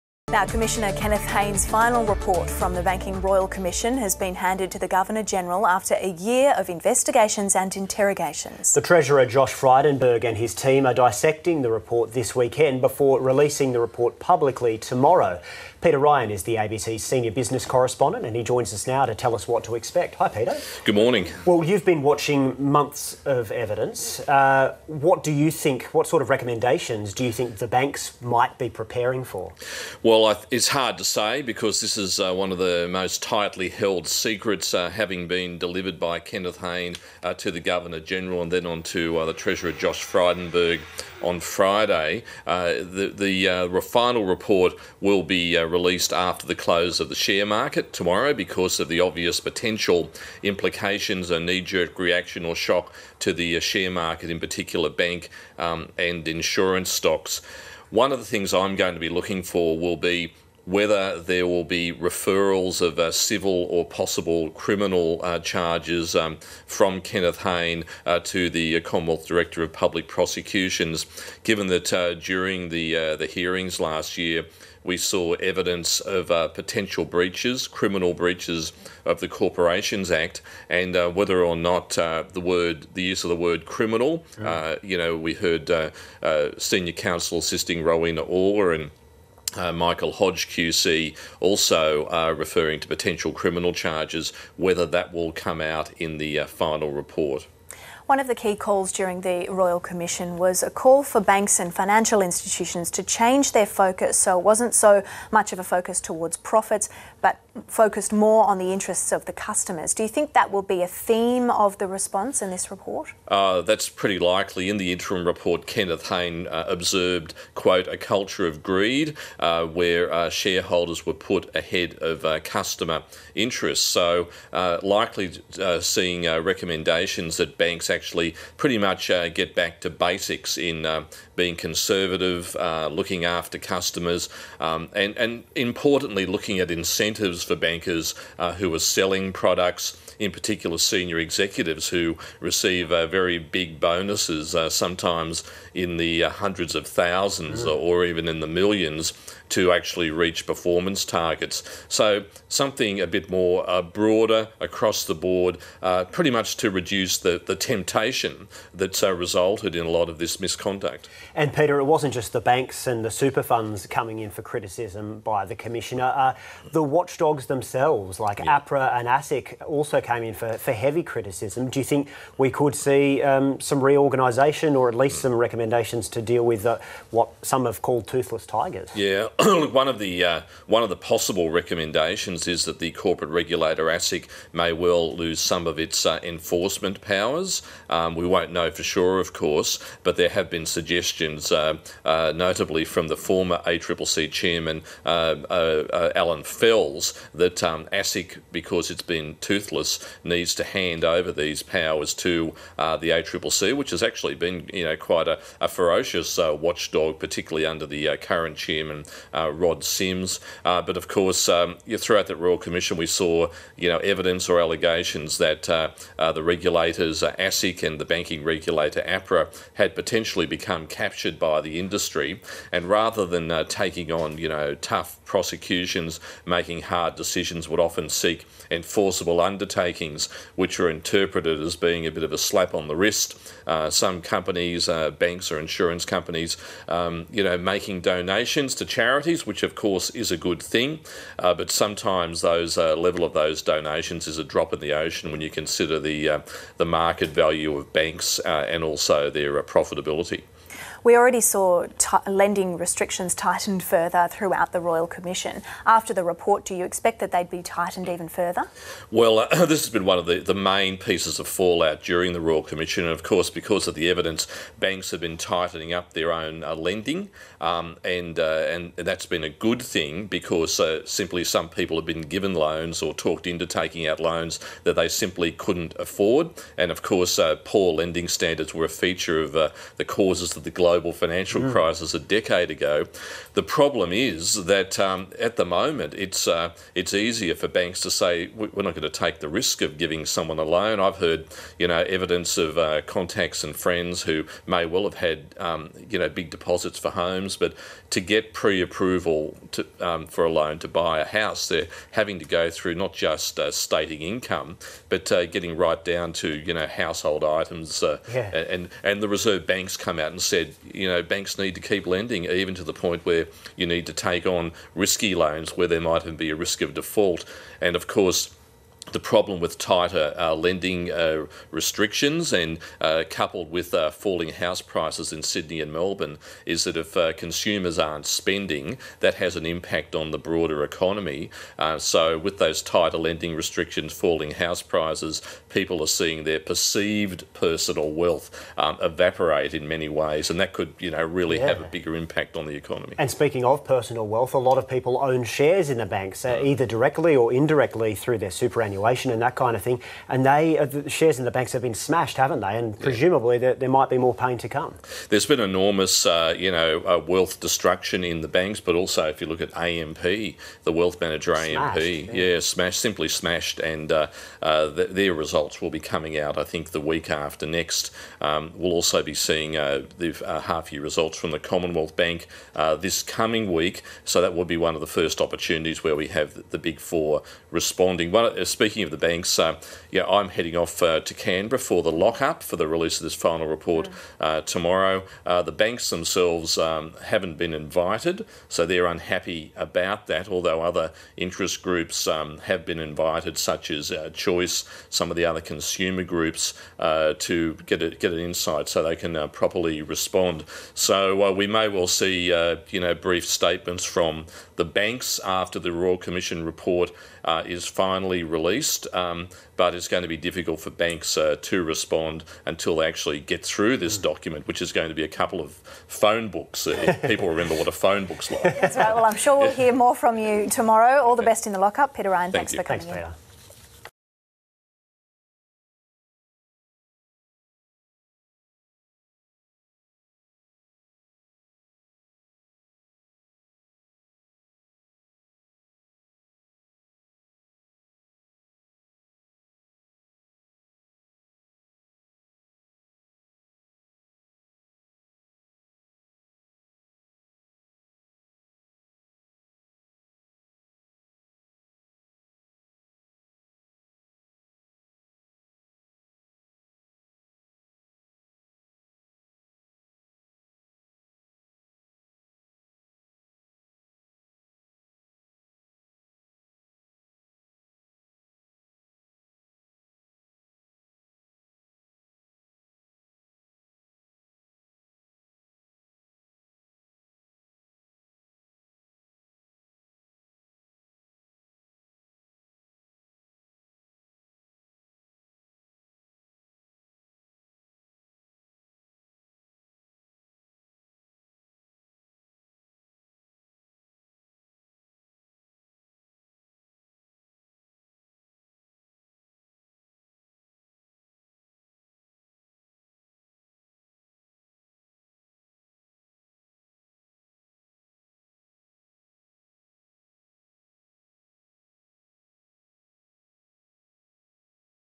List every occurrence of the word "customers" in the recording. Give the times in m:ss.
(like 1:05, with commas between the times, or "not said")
1:49, 2:02, 2:13.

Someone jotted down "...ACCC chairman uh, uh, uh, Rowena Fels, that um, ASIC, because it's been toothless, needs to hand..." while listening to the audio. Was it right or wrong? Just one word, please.
wrong.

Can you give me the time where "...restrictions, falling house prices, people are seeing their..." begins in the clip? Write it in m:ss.
5:33.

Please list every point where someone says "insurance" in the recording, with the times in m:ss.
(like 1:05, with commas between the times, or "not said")
0:56, 3:55.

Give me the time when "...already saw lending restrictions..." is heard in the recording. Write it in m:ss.
4:11.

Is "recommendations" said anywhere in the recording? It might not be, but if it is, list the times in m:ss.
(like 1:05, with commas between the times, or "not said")
0:26, 2:06, 2:55, 3:01.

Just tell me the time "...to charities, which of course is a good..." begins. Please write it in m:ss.
3:58.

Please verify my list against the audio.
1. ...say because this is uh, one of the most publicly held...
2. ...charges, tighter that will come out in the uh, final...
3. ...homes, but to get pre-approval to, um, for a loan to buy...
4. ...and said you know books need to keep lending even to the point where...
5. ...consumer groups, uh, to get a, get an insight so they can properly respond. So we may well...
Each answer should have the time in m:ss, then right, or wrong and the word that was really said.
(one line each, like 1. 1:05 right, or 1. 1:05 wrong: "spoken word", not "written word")
1. 0:31 wrong: "tightly", not "publicly"
2. 1:33 wrong: "whether", not "tighter"
3. 4:57 right
4. 5:10 wrong: "banks", not "books"
5. 6:35 right.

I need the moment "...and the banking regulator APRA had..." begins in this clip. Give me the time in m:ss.
3:37.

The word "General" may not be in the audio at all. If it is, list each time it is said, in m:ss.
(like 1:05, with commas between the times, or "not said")
0:05, 0:38.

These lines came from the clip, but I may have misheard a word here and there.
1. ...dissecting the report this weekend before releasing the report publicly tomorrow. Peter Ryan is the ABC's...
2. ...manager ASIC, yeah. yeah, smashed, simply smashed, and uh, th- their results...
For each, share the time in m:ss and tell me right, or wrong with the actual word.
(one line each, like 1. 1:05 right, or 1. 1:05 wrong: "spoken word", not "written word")
1. 0:10 right
2. 6:01 wrong: "AMP", not "ASIC".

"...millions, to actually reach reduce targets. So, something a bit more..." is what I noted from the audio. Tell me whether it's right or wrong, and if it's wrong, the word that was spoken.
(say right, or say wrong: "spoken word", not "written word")
wrong: "performance", not "reduce".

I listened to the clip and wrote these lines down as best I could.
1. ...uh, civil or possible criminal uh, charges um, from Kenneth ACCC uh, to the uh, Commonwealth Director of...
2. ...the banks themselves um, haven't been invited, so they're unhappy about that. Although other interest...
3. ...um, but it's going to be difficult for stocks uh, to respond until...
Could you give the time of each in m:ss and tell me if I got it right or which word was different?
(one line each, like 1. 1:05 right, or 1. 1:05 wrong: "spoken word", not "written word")
1. 1:02 wrong: "Hayne", not "ACCC"
2. 6:25 right
3. 6:49 wrong: "banks", not "stocks".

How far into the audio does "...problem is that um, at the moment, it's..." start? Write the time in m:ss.
4:43.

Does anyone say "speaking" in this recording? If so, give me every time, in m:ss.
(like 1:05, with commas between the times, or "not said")
5:43, 6:18.